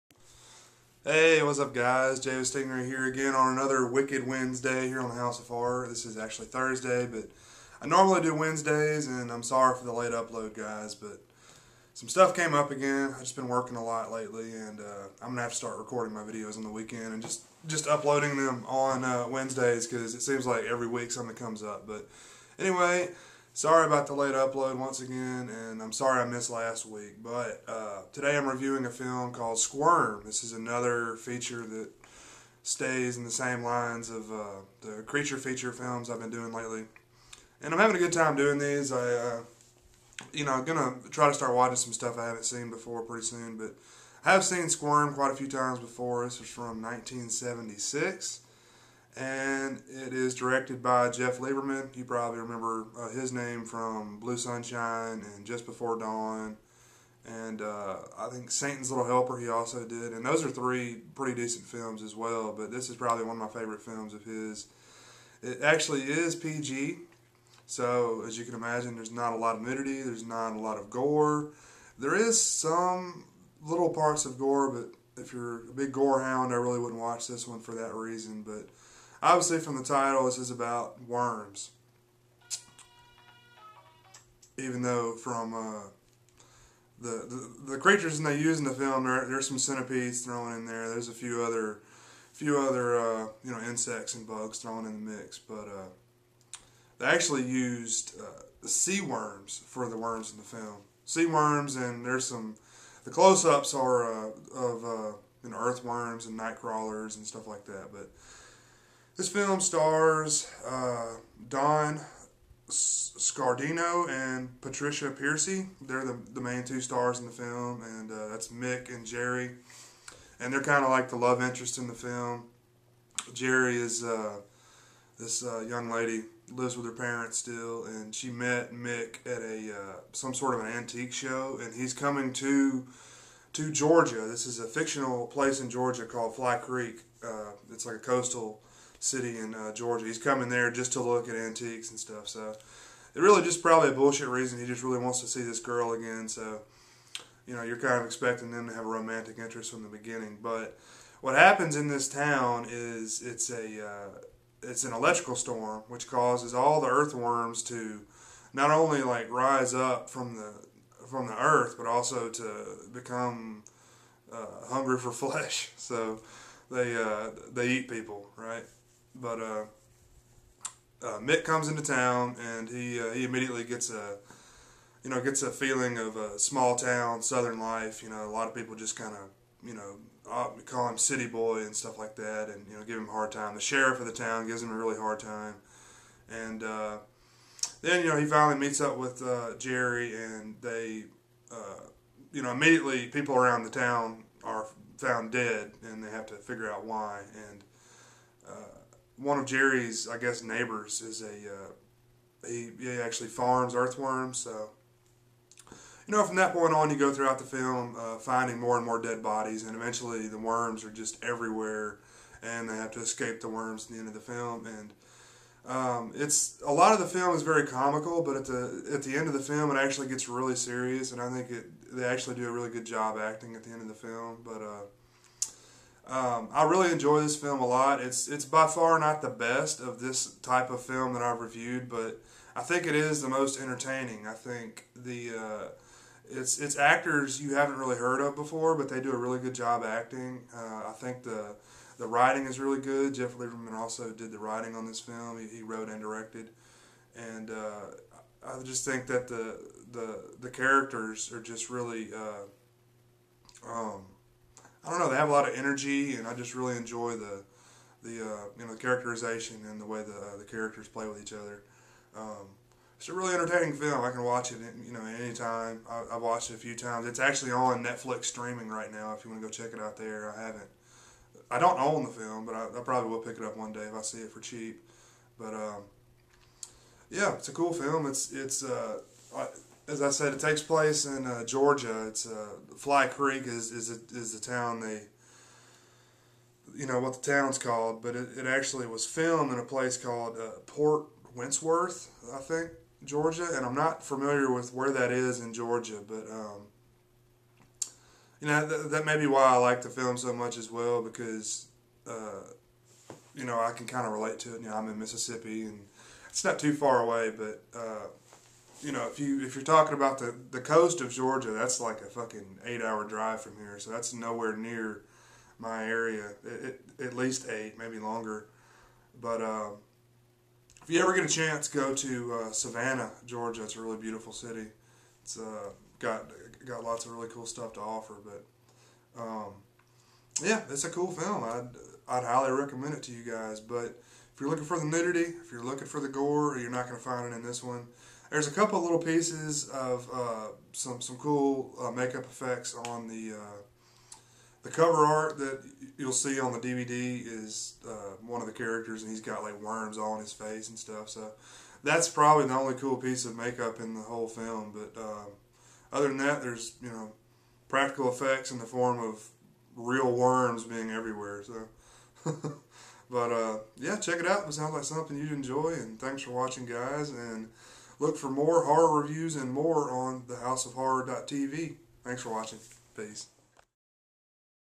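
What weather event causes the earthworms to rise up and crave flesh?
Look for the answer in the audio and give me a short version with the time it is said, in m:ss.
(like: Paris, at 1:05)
An electrical storm, at 2:34.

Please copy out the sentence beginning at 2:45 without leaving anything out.
So they uh, they eat people, right?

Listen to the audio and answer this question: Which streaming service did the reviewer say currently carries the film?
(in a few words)
Netflix.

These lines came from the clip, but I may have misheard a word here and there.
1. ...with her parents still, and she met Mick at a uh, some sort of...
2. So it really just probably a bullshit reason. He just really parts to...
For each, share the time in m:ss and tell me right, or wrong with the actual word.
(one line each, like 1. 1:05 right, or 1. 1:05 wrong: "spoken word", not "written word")
1. 2:06 right
2. 2:22 wrong: "wants", not "parts".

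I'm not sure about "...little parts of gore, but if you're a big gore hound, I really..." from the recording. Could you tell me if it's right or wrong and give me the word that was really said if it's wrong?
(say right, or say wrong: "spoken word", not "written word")
right.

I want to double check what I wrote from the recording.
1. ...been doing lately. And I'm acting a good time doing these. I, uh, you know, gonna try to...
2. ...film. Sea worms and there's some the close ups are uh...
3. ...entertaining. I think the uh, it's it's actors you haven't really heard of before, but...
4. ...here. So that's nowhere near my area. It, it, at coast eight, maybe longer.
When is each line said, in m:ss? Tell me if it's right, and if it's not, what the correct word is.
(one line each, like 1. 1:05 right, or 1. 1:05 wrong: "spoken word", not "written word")
1. 0:36 wrong: "having", not "acting"
2. 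1:40 right
3. 3:53 right
4. 5:13 wrong: "least", not "coast".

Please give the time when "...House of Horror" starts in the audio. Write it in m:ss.
0:05.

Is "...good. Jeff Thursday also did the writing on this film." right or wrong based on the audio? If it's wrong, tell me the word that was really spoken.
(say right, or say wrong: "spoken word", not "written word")
wrong: "Lieberman", not "Thursday".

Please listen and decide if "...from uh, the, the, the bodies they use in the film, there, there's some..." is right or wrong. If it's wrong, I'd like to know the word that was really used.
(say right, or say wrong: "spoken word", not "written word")
wrong: "creatures", not "bodies".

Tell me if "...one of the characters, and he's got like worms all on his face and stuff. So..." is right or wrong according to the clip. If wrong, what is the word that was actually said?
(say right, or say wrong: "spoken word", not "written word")
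right.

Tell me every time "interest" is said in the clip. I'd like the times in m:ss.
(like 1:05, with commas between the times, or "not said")
2:01, 2:29.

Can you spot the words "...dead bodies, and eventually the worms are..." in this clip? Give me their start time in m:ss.
3:29.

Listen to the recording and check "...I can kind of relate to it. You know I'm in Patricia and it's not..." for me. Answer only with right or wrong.
wrong.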